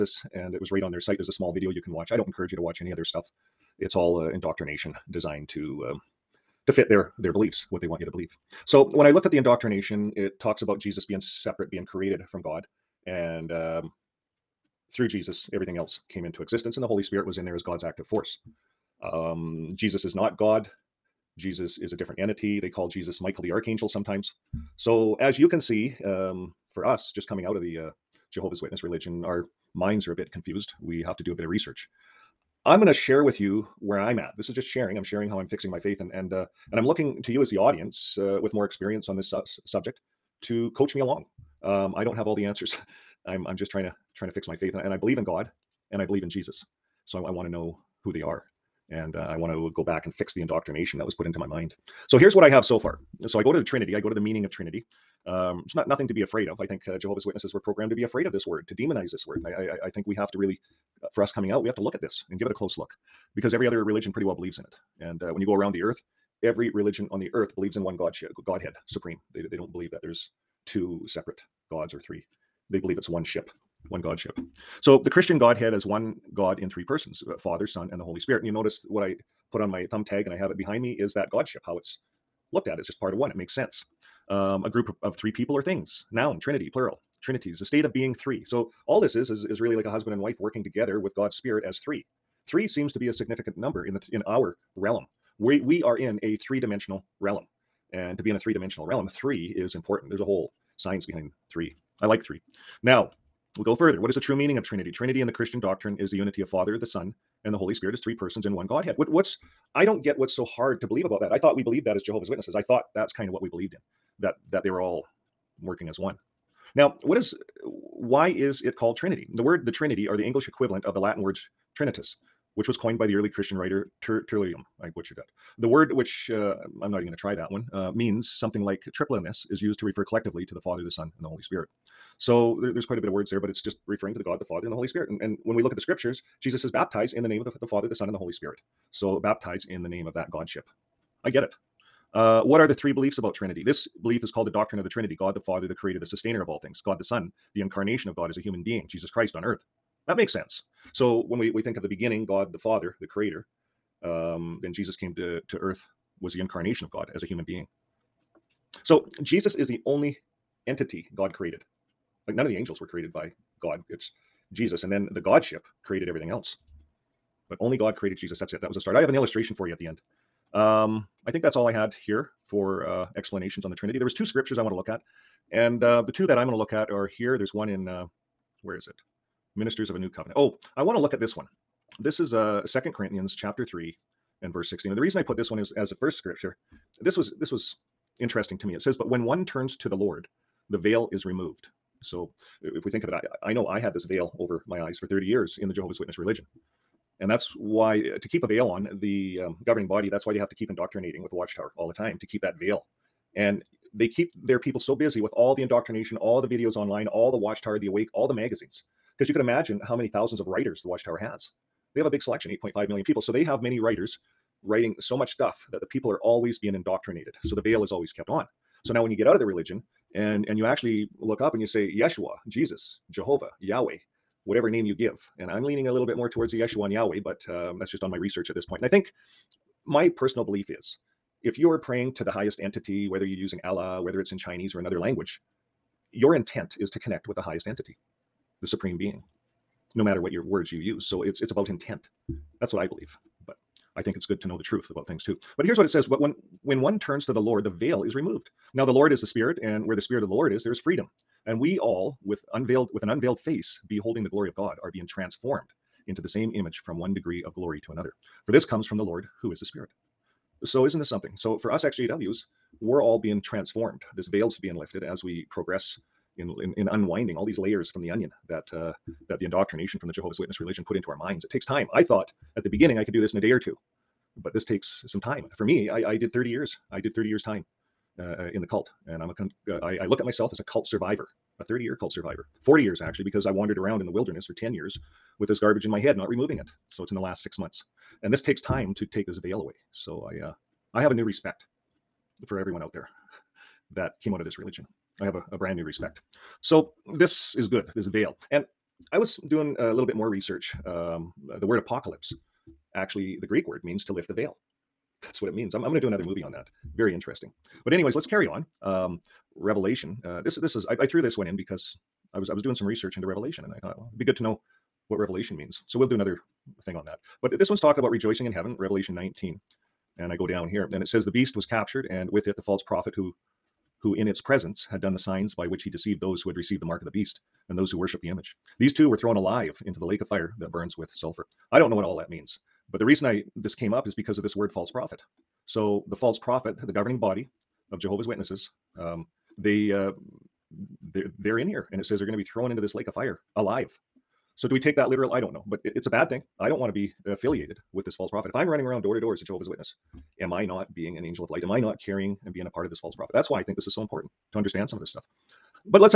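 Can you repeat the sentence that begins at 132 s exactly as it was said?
So there, there's quite a bit of words there, but it's just referring to the God, the Father, and the Holy Spirit.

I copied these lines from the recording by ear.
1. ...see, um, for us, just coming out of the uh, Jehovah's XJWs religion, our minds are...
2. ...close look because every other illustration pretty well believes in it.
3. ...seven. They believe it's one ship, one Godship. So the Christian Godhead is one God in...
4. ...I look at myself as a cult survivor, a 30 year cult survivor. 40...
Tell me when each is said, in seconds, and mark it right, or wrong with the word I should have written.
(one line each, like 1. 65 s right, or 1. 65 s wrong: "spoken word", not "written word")
1. 25 s wrong: "Witness", not "XJWs"
2. 62 s wrong: "religion", not "illustration"
3. 72 s wrong: "three", not "seven"
4. 280 s right.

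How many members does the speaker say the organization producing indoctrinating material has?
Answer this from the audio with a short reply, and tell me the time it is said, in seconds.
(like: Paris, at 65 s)
8.5 million, at 212 s.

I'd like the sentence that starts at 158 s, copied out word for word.
So Jesus is the only entity God created.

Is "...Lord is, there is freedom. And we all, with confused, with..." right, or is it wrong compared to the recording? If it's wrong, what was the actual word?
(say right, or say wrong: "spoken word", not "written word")
wrong: "unveiled", not "confused".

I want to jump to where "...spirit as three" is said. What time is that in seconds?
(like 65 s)
91 s.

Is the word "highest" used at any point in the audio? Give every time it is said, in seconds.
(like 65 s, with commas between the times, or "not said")
232 s, 237 s.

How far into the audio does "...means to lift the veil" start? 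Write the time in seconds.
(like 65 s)
303 s.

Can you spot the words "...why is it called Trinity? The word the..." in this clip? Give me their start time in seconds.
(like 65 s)
117 s.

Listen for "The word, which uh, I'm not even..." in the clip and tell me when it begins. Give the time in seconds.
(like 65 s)
125 s.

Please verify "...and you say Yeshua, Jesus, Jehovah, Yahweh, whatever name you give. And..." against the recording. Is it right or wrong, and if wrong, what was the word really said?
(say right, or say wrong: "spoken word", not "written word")
right.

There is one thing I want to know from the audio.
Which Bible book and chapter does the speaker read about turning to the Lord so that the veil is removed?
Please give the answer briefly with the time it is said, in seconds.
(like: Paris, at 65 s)
Second Corinthians 3, at 182 s.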